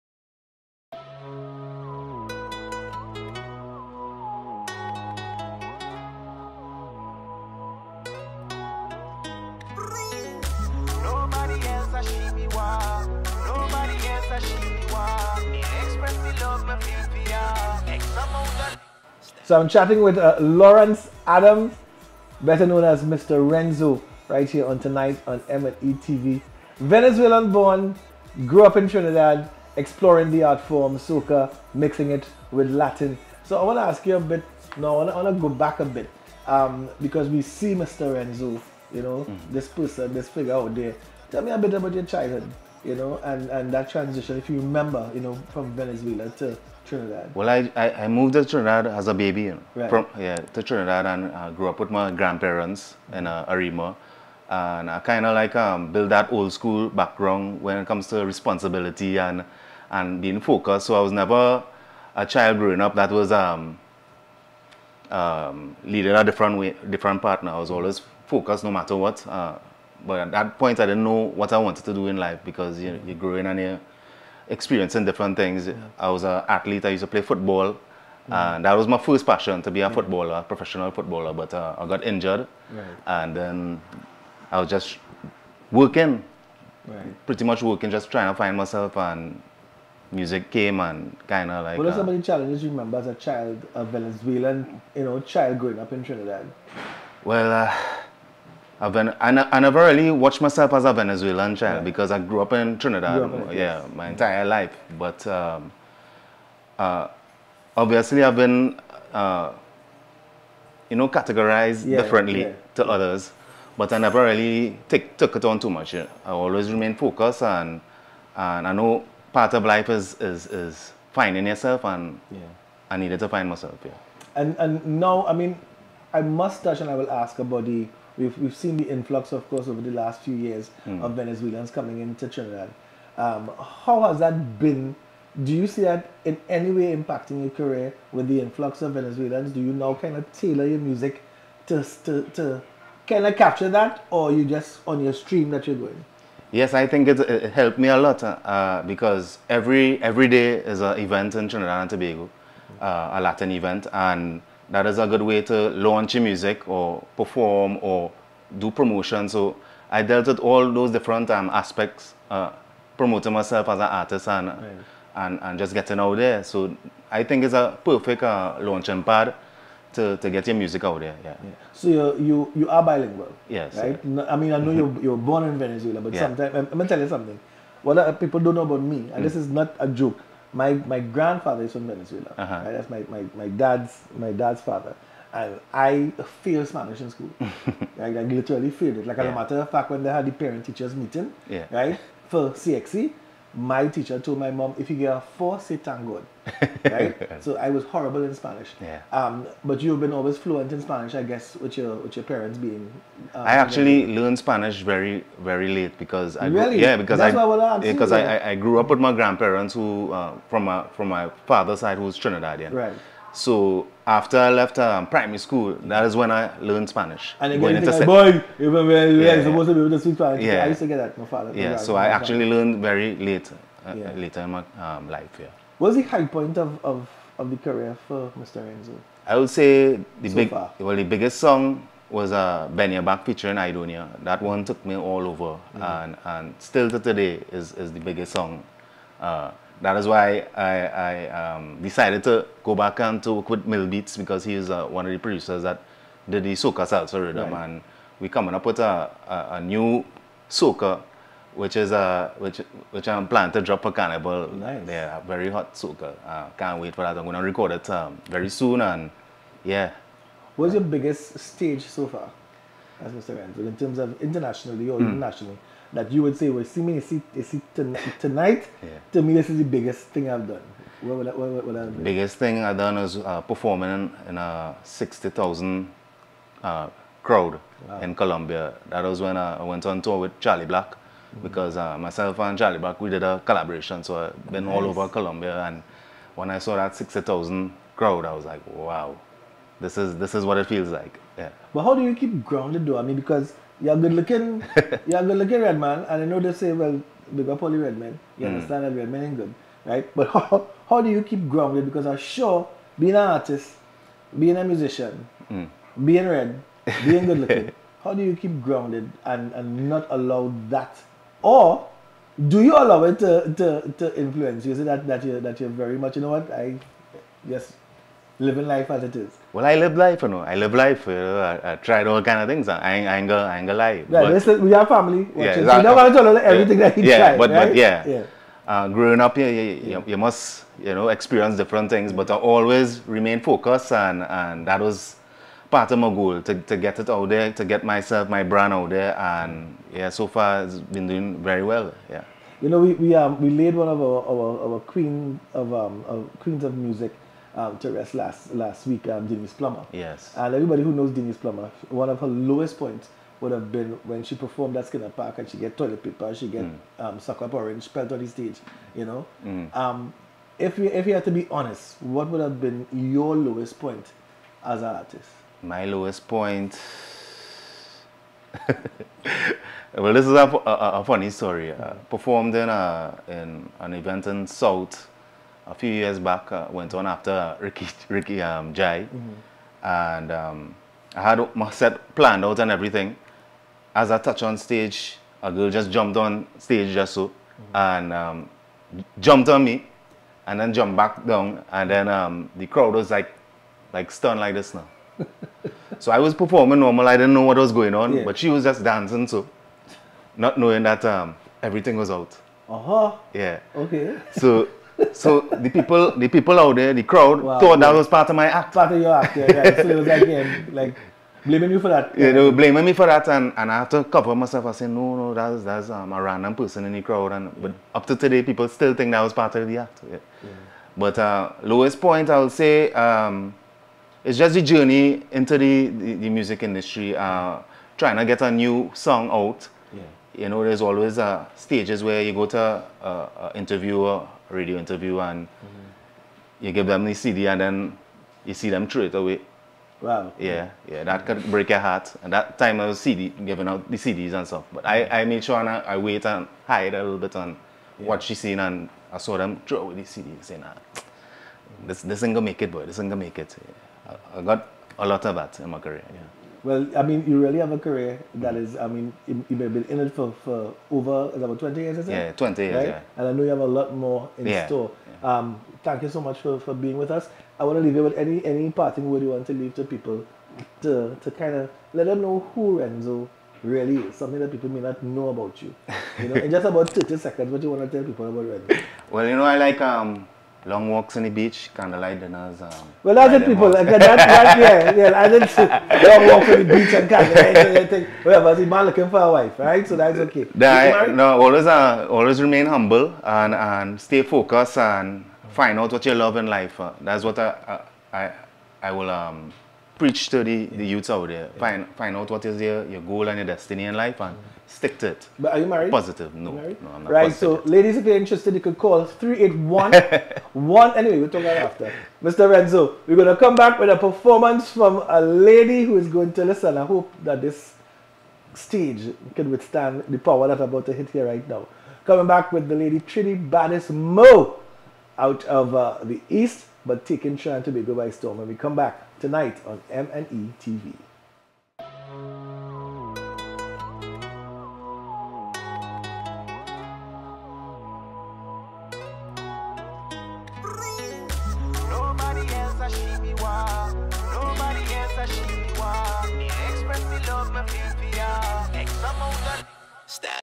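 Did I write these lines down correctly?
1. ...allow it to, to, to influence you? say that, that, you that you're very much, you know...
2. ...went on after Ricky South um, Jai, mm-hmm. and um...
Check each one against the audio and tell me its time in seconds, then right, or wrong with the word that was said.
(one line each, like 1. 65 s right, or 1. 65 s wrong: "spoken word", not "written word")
1. 312 s right
2. 376 s wrong: "Ricky", not "South".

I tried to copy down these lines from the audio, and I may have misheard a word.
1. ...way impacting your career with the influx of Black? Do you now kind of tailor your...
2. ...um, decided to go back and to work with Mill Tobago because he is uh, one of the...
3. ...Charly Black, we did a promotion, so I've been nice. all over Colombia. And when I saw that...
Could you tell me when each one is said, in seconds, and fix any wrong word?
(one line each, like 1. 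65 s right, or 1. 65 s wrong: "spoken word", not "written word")
1. 136 s wrong: "Venezuelans", not "Black"
2. 241 s wrong: "Beats", not "Tobago"
3. 282 s wrong: "collaboration", not "promotion".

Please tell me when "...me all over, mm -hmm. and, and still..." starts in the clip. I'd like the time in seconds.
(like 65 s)
234 s.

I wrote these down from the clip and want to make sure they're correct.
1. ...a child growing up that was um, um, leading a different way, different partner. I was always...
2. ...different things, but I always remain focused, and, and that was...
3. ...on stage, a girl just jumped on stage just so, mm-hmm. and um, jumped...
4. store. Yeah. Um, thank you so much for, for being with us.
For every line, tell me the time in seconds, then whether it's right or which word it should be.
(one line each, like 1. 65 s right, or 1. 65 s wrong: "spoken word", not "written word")
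1. 62 s right
2. 331 s right
3. 384 s right
4. 464 s right.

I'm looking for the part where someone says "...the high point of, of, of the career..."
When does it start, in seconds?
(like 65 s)
225 s.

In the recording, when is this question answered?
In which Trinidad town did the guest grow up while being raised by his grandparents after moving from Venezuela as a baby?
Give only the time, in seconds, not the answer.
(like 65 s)
53 s.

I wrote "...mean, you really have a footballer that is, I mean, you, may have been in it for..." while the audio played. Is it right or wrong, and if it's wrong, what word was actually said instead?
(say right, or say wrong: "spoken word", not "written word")
wrong: "career", not "footballer".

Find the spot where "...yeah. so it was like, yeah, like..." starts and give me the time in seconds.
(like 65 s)
409 s.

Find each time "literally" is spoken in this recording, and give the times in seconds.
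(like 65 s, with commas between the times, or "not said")
188 s.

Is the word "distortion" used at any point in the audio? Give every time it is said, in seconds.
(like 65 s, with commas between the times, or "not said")
not said.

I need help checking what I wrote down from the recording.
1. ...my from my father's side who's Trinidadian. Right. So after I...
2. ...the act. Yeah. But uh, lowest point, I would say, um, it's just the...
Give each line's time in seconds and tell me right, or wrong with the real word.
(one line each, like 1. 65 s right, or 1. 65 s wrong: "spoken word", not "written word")
1. 210 s right
2. 419 s right.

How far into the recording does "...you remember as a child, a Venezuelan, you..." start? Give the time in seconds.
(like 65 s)
92 s.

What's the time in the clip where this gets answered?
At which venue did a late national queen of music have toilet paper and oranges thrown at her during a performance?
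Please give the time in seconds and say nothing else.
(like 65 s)
354 s.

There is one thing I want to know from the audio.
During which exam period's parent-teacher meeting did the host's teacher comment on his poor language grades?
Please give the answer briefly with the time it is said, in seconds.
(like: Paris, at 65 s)
CXC, at 192 s.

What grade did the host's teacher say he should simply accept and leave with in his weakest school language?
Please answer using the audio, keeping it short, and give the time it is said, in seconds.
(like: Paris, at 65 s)
4, at 195 s.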